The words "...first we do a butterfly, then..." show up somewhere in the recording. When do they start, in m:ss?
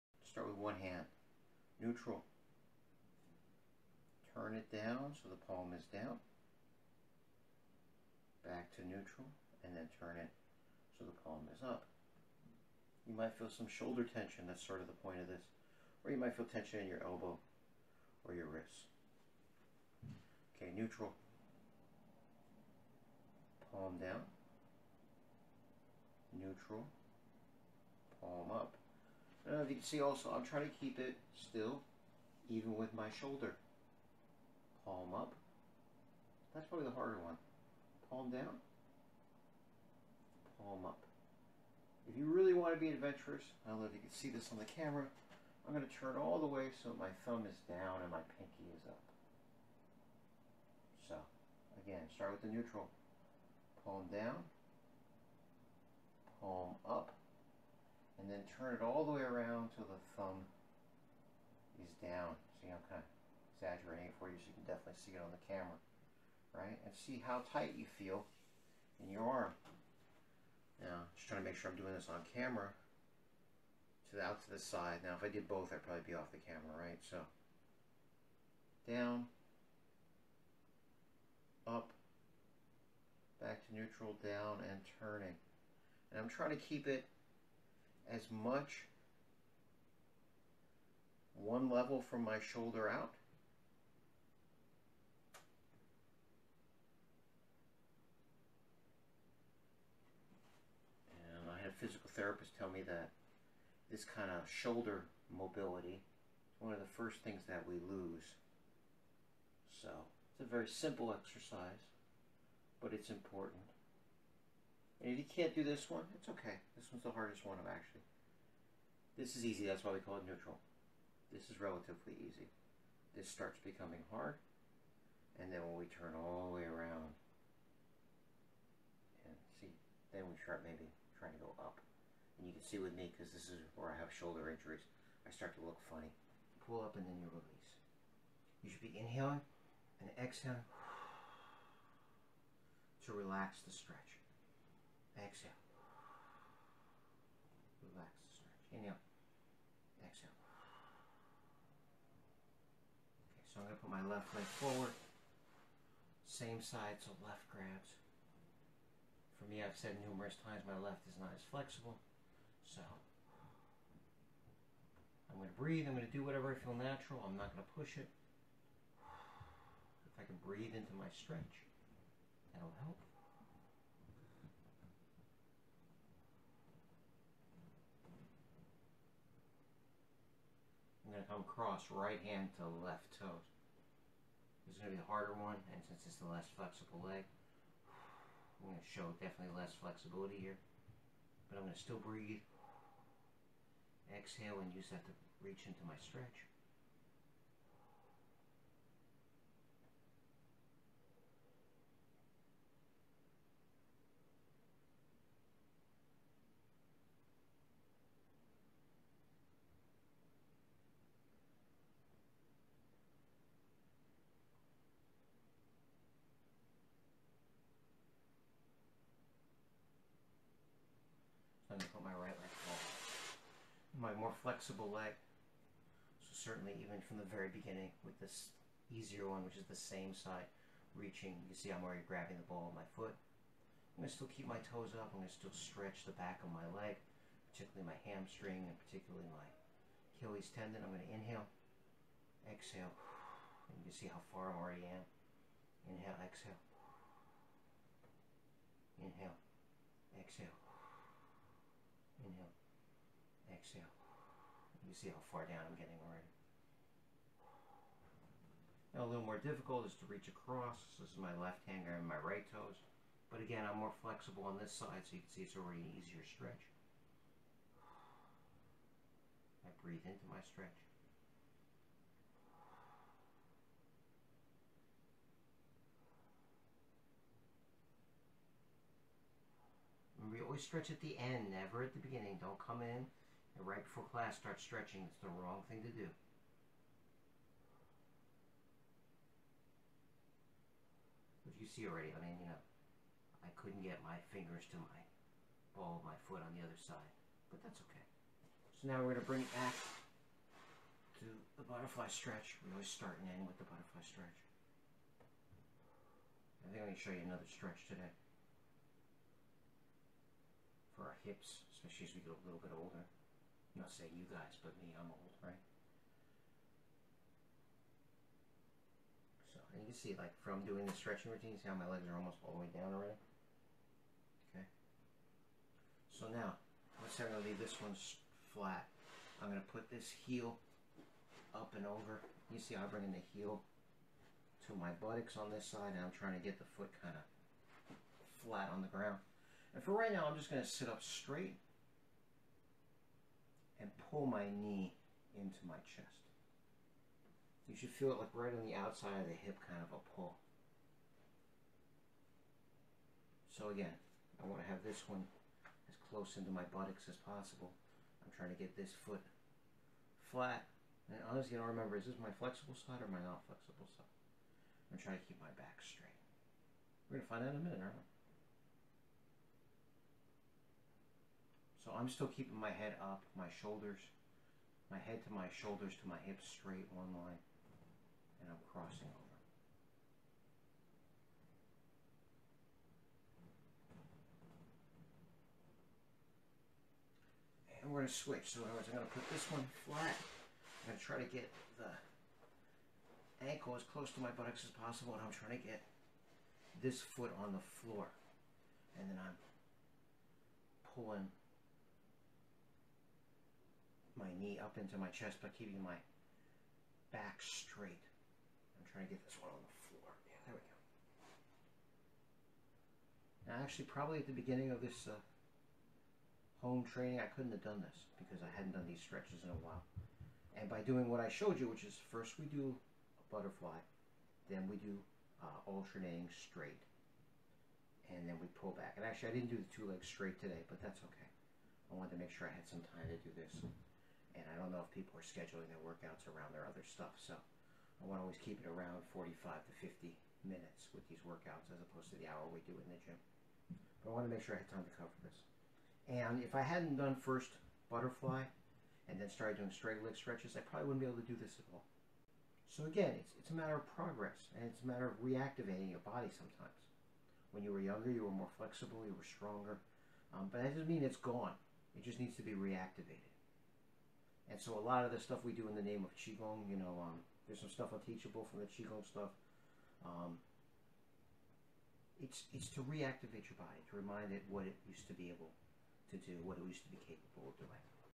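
7:02.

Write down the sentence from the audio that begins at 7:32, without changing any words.
So again, it's, it's a matter of progress and it's a matter of reactivating your body sometimes.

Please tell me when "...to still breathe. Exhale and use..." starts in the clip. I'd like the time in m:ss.
3:11.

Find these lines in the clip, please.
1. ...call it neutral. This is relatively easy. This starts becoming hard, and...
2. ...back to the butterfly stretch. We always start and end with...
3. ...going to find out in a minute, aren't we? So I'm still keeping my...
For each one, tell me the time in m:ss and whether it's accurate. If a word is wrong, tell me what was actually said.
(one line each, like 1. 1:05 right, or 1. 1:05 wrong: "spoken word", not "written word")
1. 1:59 right
2. 4:59 right
3. 6:07 right.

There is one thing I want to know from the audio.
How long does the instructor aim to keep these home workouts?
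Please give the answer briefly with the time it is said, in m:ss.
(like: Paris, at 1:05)
45 to 50 minutes, at 7:19.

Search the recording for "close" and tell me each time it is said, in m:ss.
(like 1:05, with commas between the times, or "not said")
5:56, 6:33.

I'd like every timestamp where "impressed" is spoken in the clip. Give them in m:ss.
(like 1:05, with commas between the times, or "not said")
not said.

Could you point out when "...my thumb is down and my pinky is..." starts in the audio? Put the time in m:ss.
0:46.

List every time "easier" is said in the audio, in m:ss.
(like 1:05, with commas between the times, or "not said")
3:48, 4:25.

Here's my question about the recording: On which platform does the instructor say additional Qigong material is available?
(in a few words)
Teachable.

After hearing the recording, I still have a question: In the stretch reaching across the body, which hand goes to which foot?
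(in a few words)
Right hand to left toes.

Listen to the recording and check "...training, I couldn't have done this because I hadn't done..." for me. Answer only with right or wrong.
right.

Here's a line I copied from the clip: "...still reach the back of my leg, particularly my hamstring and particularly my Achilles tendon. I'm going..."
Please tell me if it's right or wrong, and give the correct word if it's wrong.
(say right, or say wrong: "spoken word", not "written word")
wrong: "stretch", not "reach".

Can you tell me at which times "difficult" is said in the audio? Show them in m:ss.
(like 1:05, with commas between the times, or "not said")
4:19.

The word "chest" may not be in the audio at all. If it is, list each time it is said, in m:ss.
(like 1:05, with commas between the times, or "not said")
5:45, 6:45.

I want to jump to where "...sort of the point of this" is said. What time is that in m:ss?
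0:14.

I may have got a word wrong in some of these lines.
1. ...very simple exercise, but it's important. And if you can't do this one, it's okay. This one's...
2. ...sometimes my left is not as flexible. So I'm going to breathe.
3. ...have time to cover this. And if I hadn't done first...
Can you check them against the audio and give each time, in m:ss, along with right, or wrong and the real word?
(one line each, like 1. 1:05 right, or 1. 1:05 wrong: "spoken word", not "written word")
1. 1:50 right
2. 2:40 wrong: "times", not "sometimes"
3. 7:24 right.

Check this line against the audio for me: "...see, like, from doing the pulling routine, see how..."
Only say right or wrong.
wrong.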